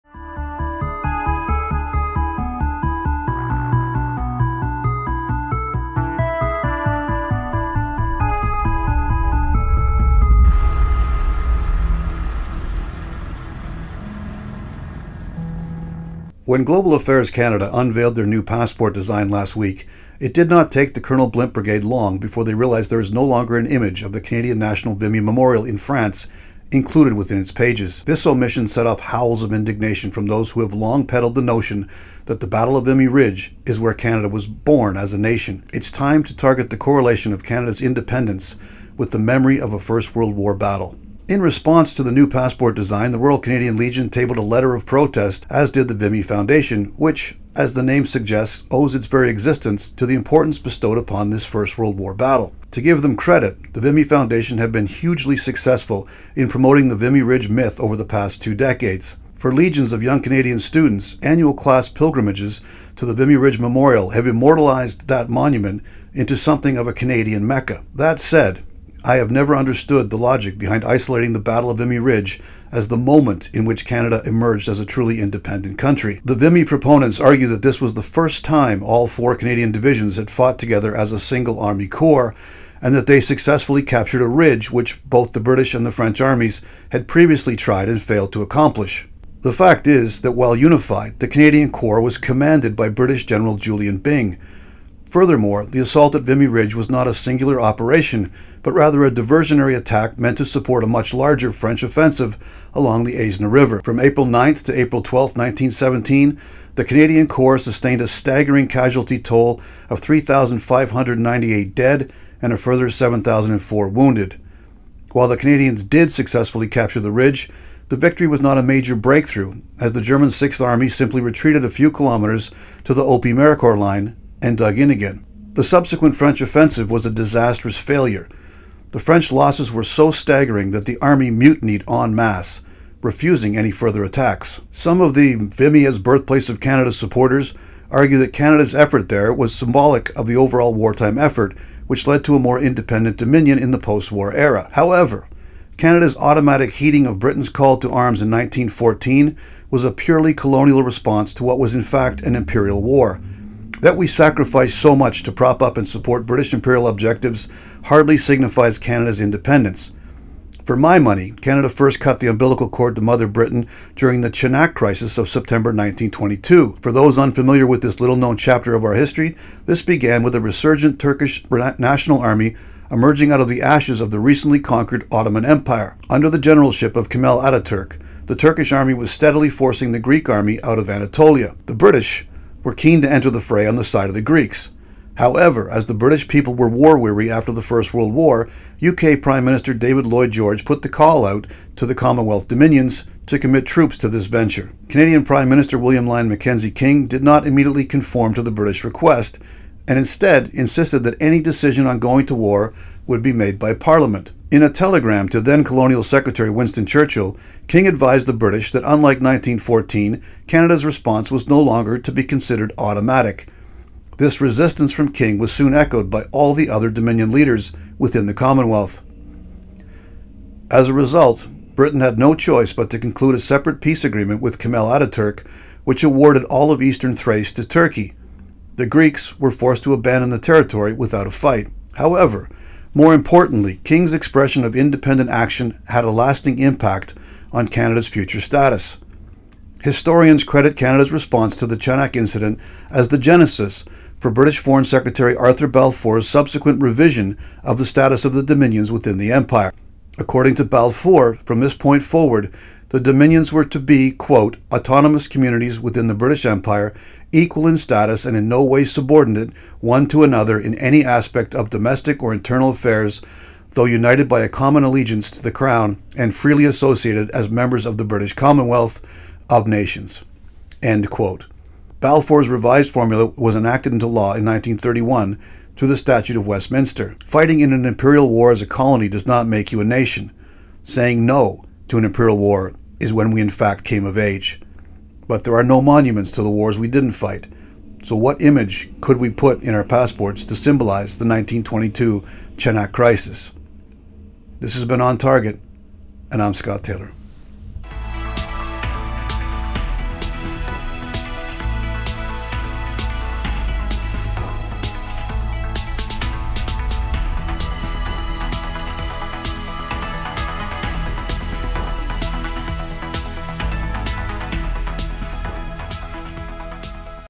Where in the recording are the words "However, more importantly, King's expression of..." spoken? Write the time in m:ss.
3:51.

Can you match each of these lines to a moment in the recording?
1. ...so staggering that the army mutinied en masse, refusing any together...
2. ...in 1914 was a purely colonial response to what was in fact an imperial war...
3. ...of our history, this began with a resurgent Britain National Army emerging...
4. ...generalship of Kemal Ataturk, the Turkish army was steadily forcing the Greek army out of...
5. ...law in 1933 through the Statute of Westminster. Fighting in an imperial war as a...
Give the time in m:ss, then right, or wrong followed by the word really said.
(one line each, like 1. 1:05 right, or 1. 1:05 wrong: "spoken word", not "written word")
1. 2:09 wrong: "further", not "together"
2. 2:28 right
3. 2:48 wrong: "Turkish", not "Britain"
4. 2:56 right
5. 4:34 wrong: "1931", not "1933".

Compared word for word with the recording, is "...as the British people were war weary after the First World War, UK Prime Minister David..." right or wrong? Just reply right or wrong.
right.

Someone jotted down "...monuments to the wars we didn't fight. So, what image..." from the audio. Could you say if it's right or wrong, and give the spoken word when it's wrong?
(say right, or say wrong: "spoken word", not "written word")
right.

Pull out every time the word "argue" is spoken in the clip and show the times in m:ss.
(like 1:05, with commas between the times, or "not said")
1:17, 2:17.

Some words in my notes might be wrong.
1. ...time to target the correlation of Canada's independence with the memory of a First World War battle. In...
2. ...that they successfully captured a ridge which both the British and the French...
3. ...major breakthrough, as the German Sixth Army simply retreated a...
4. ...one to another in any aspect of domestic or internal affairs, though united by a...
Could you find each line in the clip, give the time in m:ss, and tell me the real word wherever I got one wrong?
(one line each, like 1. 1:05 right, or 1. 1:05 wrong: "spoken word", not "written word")
1. 0:35 right
2. 1:22 right
3. 1:58 right
4. 4:19 right.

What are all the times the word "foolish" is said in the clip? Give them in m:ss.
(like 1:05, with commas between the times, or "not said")
not said.